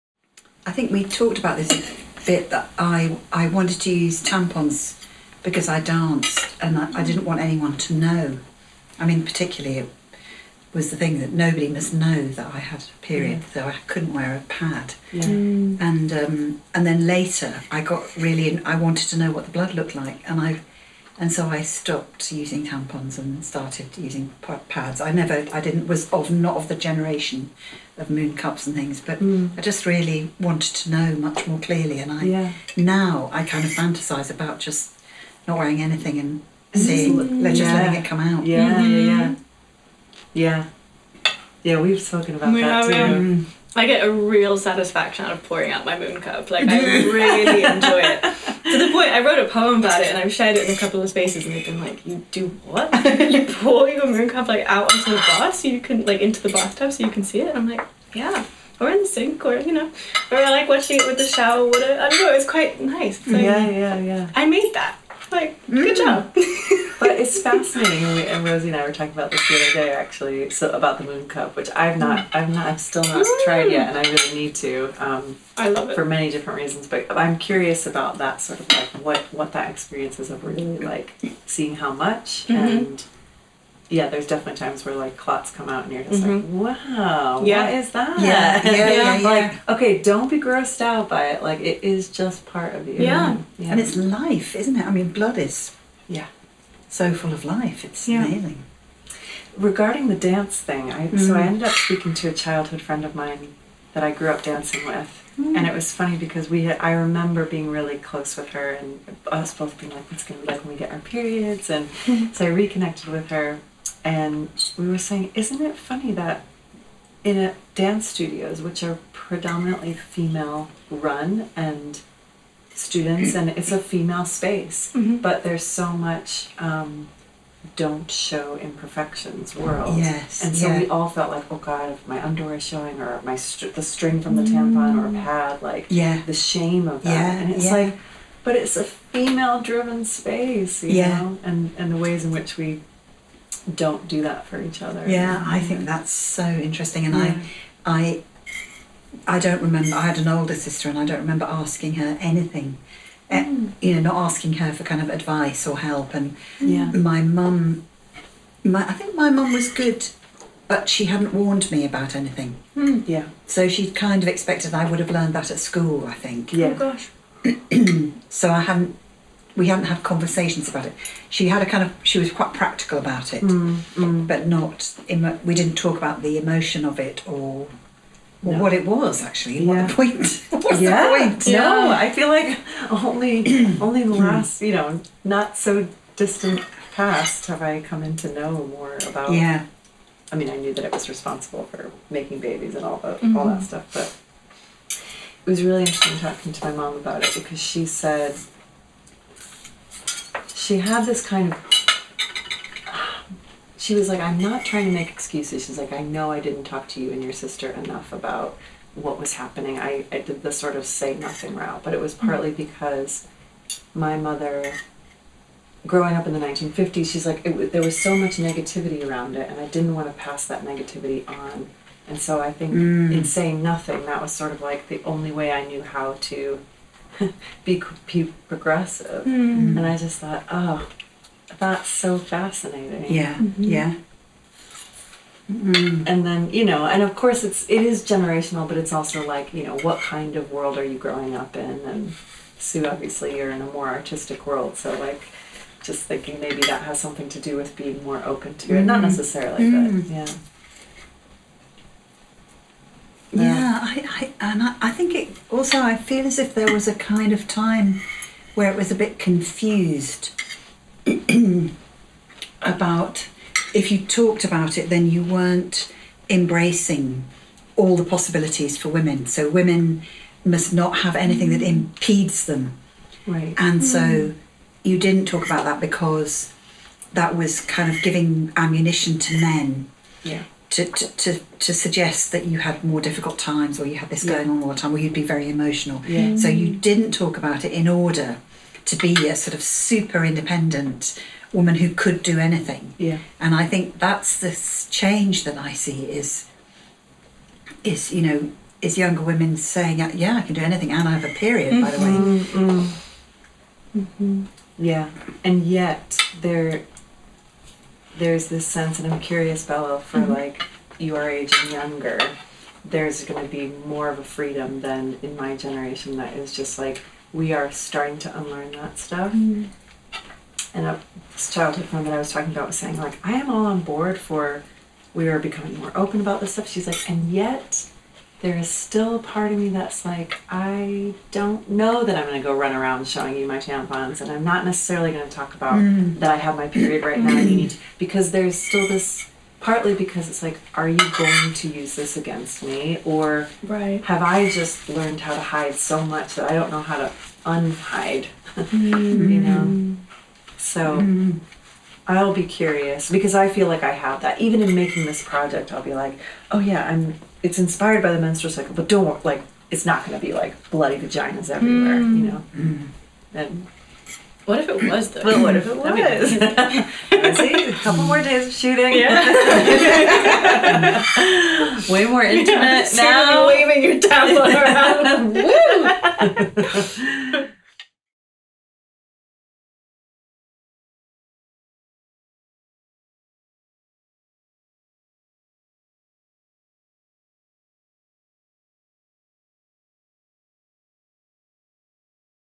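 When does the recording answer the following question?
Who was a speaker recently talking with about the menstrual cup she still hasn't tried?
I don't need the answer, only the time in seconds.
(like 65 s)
68 s.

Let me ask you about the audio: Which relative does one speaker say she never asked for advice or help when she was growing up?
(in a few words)
older sister.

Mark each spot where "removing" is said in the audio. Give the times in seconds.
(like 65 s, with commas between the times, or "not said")
not said.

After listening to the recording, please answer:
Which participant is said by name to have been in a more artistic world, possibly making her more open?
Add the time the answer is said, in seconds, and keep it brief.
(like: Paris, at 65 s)
Sue, at 242 s.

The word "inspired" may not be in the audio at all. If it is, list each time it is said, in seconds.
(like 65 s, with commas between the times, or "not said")
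357 s.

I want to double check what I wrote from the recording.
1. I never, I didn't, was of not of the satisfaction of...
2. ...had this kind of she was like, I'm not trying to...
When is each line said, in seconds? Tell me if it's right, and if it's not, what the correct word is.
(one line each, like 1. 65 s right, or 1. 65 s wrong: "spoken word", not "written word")
1. 24 s wrong: "generation", not "satisfaction"
2. 200 s right.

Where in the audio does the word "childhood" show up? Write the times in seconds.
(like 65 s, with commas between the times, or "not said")
102 s, 321 s.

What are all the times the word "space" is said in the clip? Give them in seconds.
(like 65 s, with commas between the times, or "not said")
51 s, 124 s, 140 s.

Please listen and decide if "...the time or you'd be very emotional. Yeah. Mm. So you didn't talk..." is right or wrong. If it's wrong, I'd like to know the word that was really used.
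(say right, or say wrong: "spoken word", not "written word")
right.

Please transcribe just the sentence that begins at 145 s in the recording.
Yeah, I think that's so interesting, and yeah.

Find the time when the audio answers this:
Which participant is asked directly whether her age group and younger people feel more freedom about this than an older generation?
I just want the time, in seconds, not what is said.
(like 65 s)
309 s.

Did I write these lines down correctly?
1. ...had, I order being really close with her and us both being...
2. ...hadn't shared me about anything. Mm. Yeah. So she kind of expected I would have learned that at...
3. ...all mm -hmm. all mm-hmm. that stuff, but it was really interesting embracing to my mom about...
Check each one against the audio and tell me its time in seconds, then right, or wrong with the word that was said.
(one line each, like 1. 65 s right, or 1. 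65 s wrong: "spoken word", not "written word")
1. 106 s wrong: "remember", not "order"
2. 161 s wrong: "warned", not "shared"
3. 192 s wrong: "talking", not "embracing".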